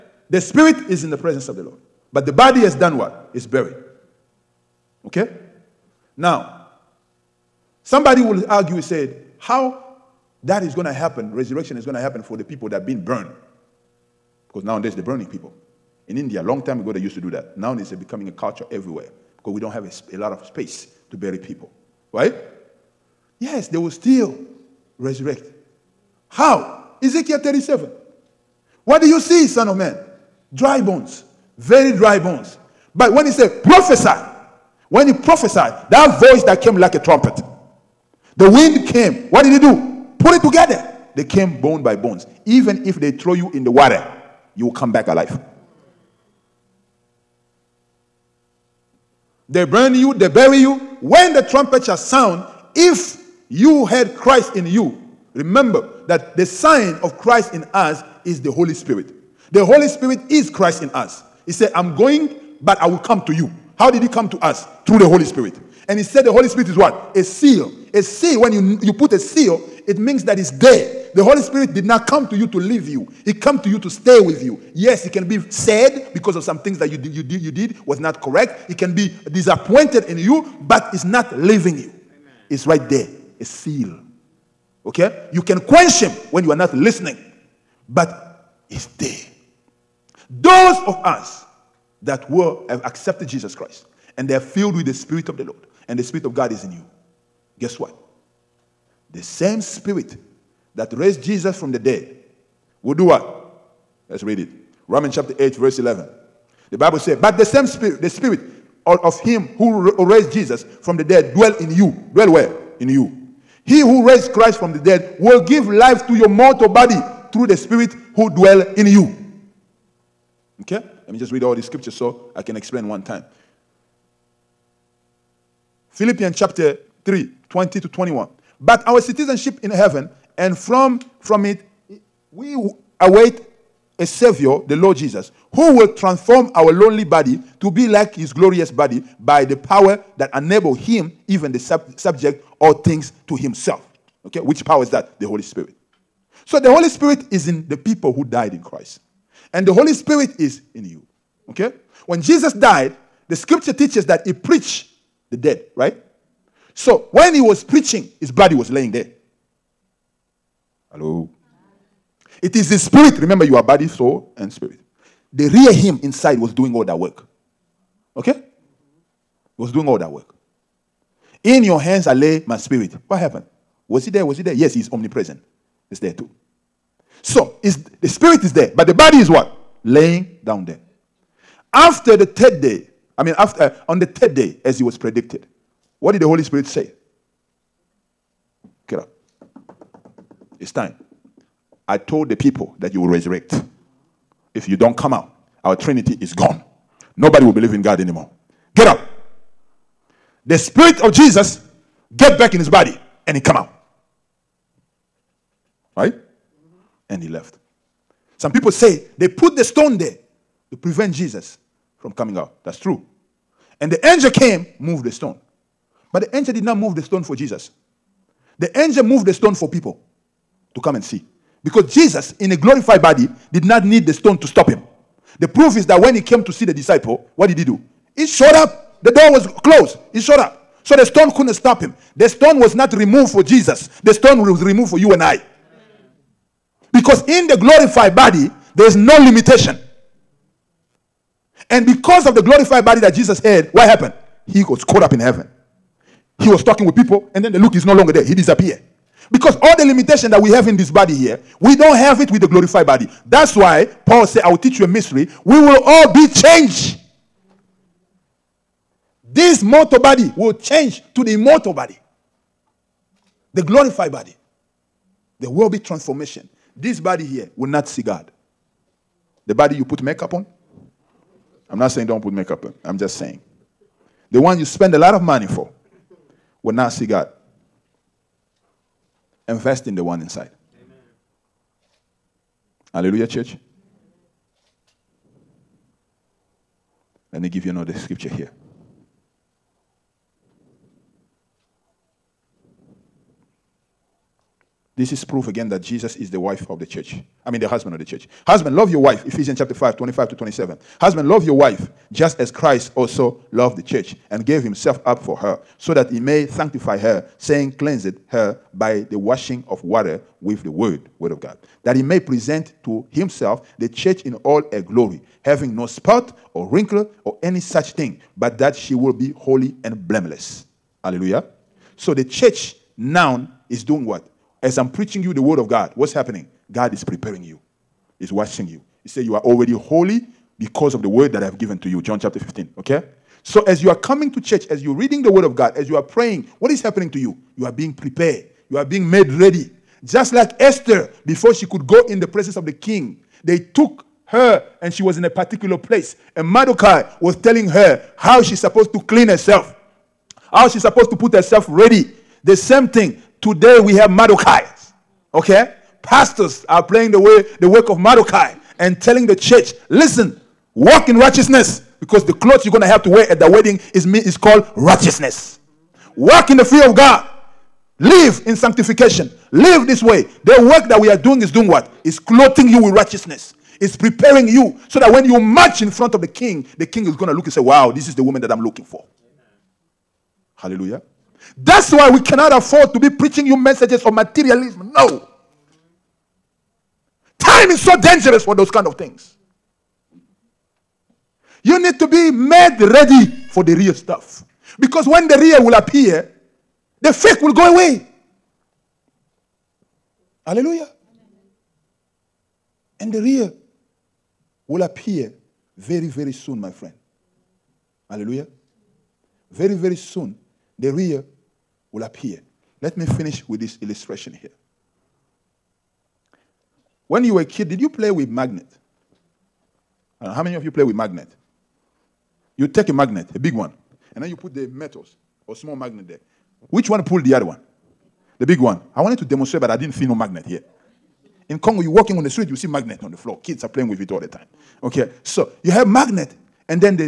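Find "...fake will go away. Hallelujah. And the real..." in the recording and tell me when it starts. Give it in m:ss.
6:37.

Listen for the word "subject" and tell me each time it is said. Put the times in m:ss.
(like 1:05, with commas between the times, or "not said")
2:21.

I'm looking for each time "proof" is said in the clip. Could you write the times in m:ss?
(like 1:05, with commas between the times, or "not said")
3:45, 4:55.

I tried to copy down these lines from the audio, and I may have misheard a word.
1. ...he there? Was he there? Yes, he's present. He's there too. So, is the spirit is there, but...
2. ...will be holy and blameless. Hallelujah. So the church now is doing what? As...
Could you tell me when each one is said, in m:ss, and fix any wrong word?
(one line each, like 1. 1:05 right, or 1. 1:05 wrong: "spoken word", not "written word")
1. 2:54 wrong: "omnipresent", not "present"
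2. 5:18 right.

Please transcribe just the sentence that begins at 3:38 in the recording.
The angel moved the stone for people to come and see.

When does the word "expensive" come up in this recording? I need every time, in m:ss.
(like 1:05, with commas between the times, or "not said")
not said.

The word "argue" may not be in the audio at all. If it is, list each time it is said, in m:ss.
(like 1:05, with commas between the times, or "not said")
0:08.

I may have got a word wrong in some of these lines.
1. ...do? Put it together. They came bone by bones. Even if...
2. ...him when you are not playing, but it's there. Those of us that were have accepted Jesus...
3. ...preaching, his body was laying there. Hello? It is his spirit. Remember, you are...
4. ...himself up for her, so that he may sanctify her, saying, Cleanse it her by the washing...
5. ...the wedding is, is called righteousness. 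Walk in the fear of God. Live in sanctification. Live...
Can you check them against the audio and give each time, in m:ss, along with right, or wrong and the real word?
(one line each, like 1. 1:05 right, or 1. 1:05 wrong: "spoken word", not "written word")
1. 0:39 right
2. 1:26 wrong: "listening", not "playing"
3. 2:37 right
4. 5:04 right
5. 6:03 right.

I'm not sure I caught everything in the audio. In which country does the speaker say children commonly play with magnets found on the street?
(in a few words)
Congo.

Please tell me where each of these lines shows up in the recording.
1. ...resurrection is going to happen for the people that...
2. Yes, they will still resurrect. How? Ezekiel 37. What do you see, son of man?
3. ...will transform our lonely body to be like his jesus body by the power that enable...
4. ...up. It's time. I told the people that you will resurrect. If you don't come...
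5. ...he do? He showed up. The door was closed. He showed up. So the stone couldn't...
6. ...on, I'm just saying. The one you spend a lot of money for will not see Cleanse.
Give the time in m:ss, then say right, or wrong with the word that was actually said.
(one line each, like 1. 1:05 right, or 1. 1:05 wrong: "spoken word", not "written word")
1. 0:11 right
2. 0:23 right
3. 2:15 wrong: "glorious", not "jesus"
4. 3:08 right
5. 3:47 right
6. 4:32 wrong: "God", not "Cleanse".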